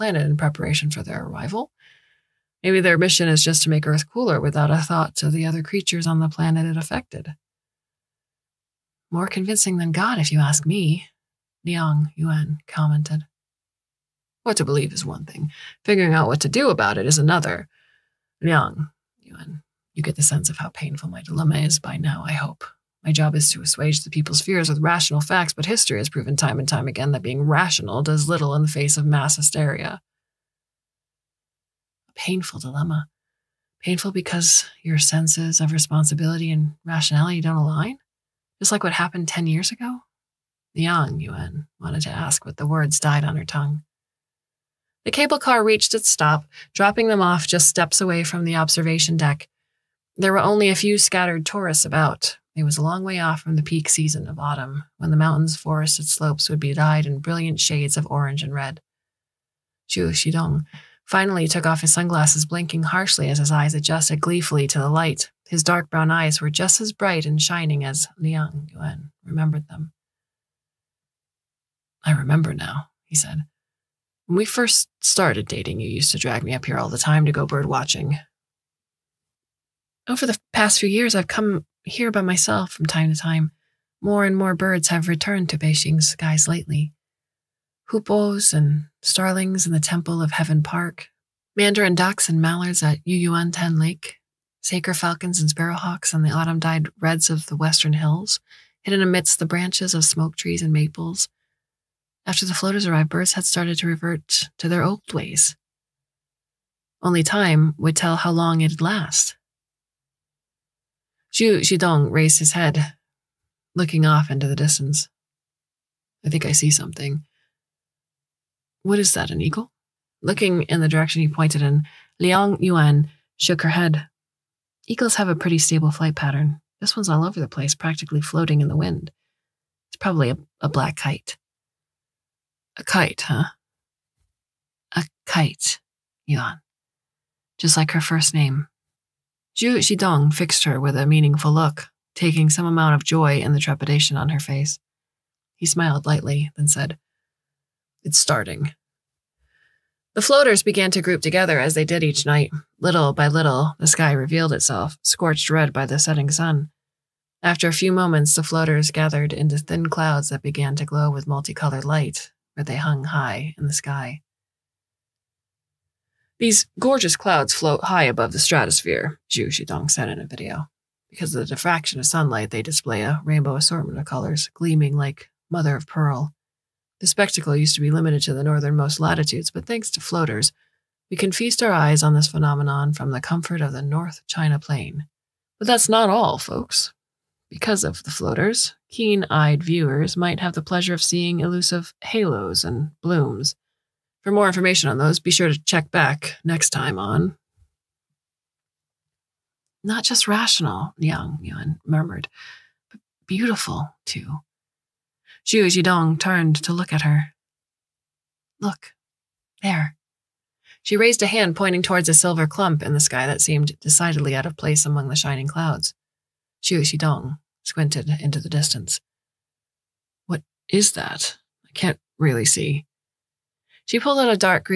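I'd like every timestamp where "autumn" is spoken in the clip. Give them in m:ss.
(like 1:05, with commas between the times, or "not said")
0:54, 1:36.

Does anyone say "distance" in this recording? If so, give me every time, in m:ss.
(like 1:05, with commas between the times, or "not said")
1:54, 3:38.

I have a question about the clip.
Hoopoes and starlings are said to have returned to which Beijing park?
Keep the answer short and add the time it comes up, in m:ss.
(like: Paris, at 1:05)
Temple of Heaven Park, at 1:29.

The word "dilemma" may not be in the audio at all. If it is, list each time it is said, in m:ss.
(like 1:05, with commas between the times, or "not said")
0:21, 0:32.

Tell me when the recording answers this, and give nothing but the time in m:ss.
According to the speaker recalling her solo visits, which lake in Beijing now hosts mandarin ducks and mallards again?
1:33.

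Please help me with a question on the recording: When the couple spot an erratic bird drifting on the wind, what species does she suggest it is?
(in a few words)
Black kite.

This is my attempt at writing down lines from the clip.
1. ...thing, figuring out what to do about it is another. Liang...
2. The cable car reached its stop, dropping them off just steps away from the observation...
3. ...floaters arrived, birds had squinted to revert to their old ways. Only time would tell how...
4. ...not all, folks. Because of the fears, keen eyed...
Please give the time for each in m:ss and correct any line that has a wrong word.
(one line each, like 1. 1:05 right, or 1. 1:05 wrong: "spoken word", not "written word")
1. 0:15 right
2. 0:45 right
3. 1:42 wrong: "started", not "squinted"
4. 3:05 wrong: "floaters", not "fears".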